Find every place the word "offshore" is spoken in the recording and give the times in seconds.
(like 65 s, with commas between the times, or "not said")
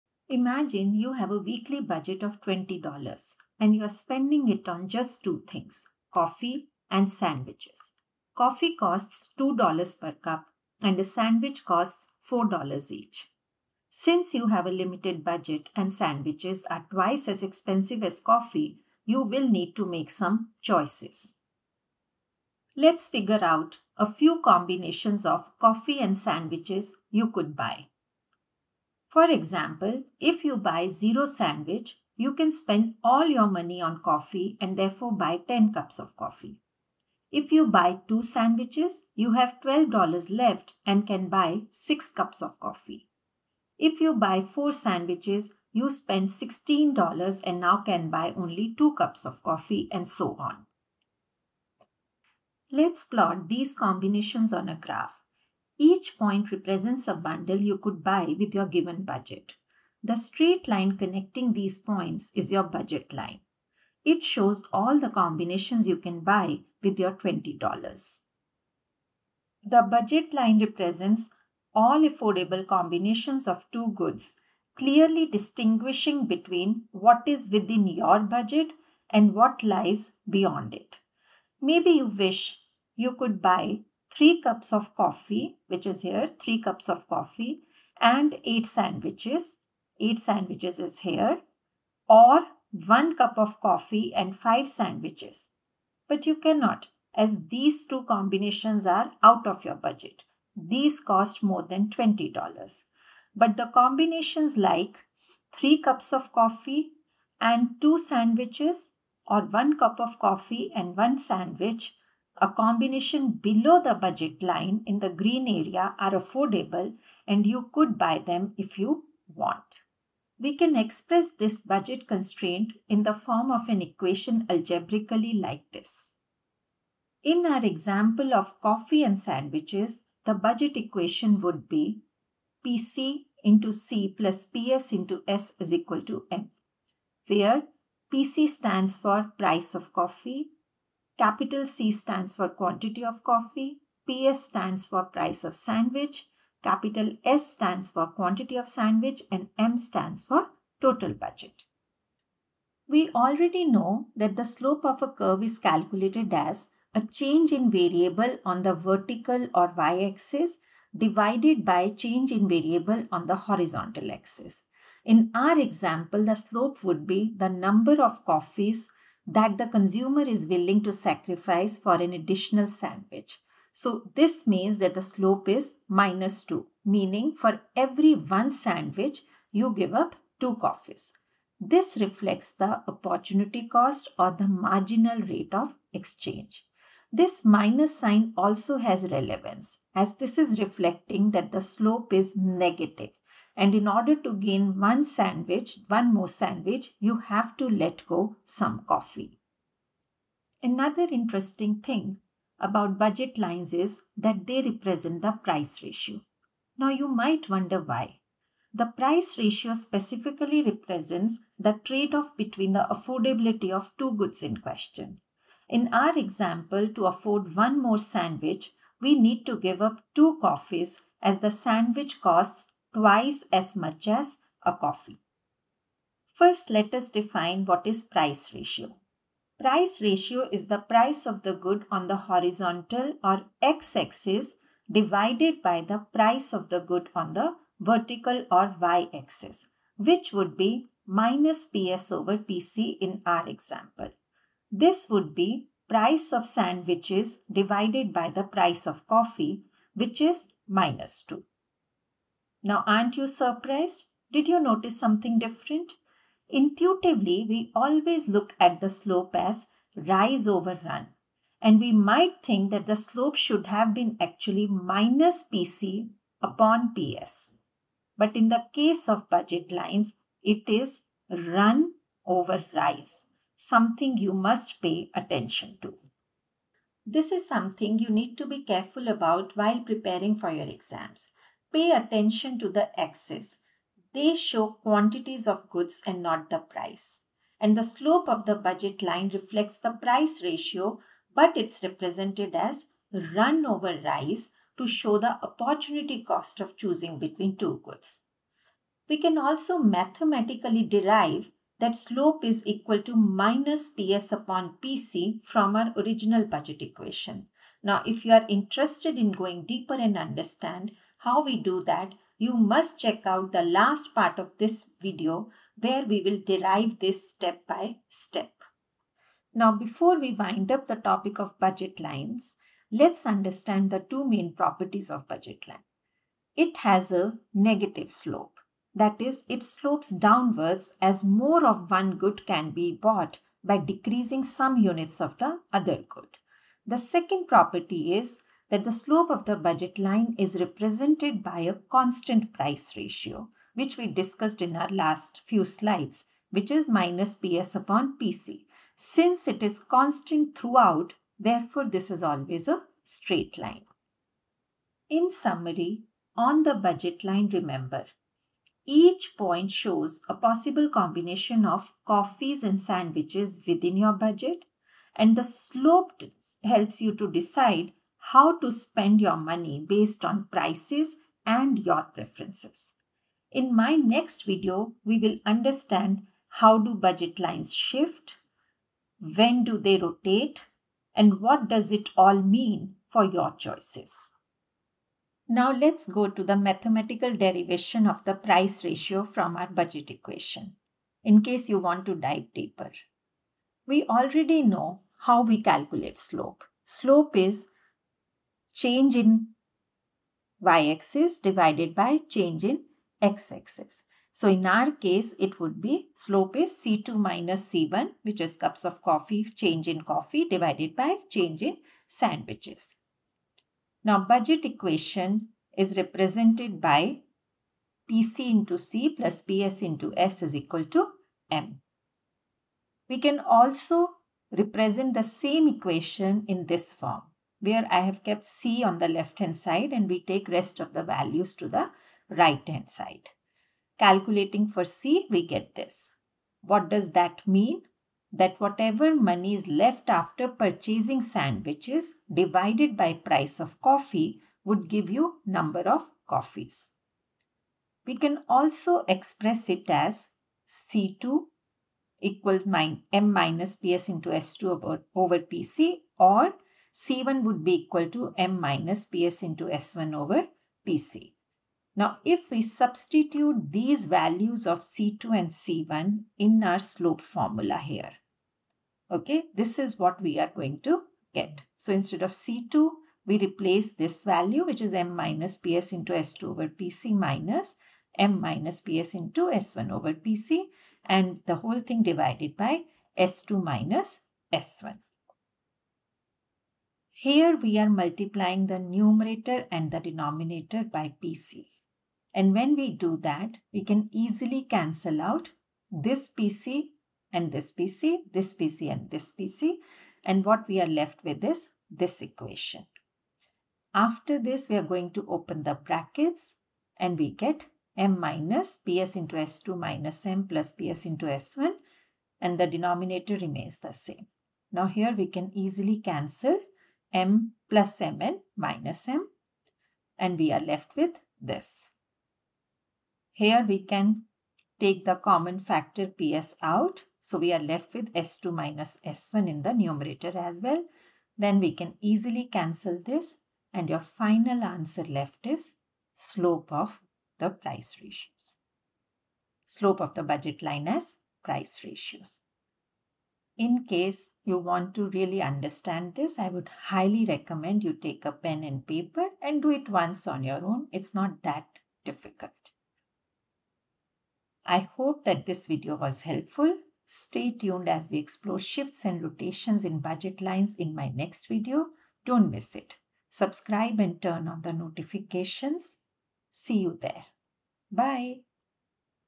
not said.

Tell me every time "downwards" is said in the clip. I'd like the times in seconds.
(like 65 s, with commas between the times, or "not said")
330 s.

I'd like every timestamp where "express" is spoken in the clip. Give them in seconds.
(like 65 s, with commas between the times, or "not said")
120 s, 449 s.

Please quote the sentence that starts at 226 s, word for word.
First, let us define what is price ratio.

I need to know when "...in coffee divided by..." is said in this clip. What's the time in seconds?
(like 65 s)
409 s.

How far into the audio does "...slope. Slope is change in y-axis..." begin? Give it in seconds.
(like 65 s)
396 s.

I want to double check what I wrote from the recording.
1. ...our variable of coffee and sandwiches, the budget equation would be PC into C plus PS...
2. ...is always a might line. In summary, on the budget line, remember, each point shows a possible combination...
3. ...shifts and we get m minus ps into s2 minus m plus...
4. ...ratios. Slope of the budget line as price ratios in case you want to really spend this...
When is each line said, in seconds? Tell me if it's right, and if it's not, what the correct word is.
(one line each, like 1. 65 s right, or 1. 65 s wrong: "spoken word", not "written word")
1. 127 s wrong: "example", not "variable"
2. 352 s wrong: "straight", not "might"
3. 505 s wrong: "brackets", not "shifts"
4. 538 s wrong: "understand", not "spend".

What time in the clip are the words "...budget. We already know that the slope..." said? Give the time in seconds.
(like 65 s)
151 s.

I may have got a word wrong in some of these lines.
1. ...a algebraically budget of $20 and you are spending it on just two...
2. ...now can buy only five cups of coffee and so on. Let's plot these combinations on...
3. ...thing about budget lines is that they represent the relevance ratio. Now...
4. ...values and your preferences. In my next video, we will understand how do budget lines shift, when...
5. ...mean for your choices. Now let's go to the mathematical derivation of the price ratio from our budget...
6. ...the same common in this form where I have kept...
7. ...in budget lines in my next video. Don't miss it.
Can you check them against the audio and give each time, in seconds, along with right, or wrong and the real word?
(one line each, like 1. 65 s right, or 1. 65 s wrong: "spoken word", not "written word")
1. 1 s wrong: "weekly", not "algebraically"
2. 47 s wrong: "two", not "five"
3. 201 s wrong: "price", not "relevance"
4. 370 s wrong: "prices", not "values"
5. 382 s right
6. 425 s wrong: "equation", not "common"
7. 559 s right.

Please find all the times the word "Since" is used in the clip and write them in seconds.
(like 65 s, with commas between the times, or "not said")
13 s, 348 s.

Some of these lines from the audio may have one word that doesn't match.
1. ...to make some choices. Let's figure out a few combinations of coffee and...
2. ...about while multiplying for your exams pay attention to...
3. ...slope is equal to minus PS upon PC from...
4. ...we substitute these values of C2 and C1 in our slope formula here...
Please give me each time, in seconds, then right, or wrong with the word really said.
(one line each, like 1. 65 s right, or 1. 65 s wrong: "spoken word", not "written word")
1. 19 s right
2. 279 s wrong: "preparing", not "multiplying"
3. 301 s right
4. 462 s right.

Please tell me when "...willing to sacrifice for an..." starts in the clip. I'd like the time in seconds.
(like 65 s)
170 s.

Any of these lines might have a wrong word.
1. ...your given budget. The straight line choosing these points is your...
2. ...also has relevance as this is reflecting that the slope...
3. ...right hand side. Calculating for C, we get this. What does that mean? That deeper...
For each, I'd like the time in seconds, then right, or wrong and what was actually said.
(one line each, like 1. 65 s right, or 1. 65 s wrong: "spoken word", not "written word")
1. 58 s wrong: "connecting", not "choosing"
2. 188 s right
3. 432 s wrong: "whatever", not "deeper".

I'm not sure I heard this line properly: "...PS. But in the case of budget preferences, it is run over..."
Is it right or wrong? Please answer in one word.
wrong.